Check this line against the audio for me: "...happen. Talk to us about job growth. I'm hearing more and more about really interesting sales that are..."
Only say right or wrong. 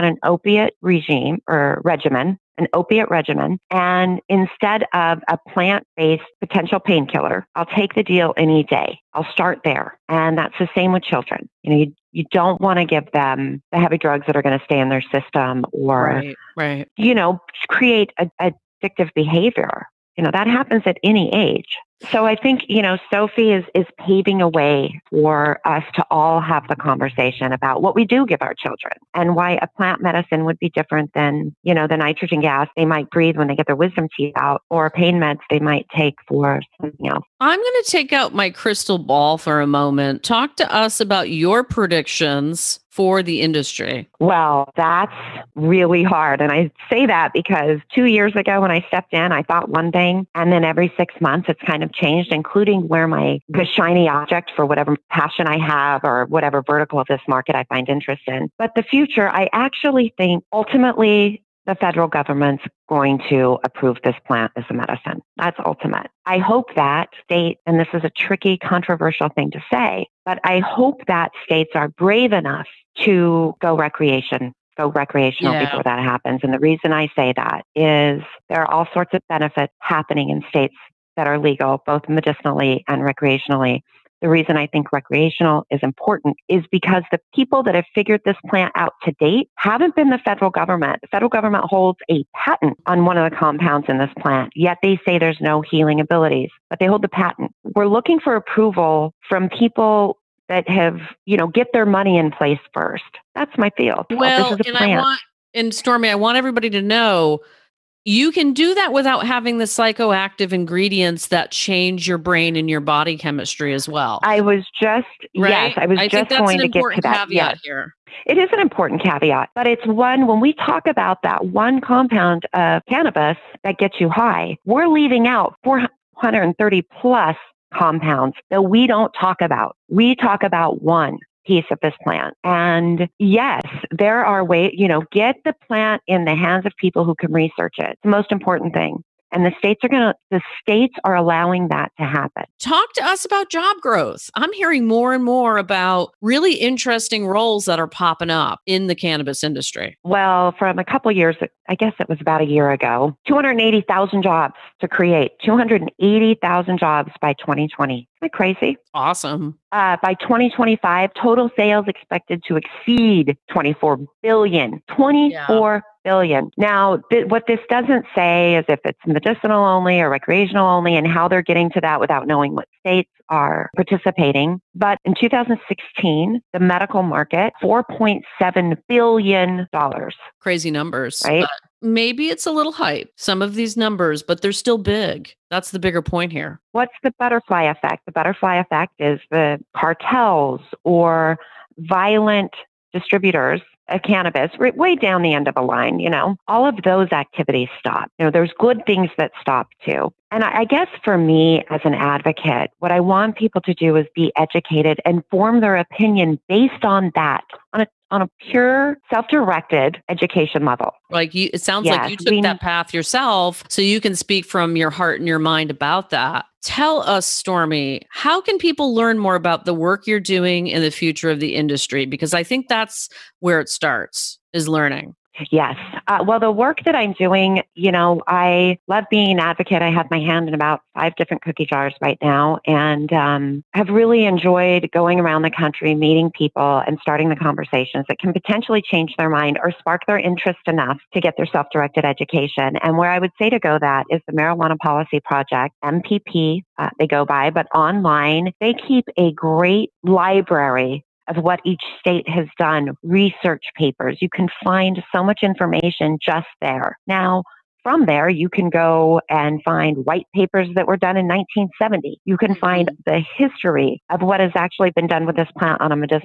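wrong.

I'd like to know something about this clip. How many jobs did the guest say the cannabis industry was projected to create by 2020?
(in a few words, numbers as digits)
280,000.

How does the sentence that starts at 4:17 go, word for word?
Now, from there, you can go and find white papers that were done in 1970.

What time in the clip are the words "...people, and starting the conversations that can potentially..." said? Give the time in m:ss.
3:56.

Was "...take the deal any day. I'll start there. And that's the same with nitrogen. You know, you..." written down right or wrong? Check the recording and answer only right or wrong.
wrong.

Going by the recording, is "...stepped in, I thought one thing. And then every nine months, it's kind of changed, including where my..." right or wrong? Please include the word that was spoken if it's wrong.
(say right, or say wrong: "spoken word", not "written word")
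wrong: "six", not "nine".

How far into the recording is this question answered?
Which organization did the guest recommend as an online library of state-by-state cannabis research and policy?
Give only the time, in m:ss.
4:04.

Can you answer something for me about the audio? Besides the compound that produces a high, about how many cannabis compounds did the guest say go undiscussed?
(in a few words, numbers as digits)
430 plus.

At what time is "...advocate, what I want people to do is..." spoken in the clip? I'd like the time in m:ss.
3:21.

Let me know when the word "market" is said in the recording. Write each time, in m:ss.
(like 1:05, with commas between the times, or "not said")
0:57, 2:57.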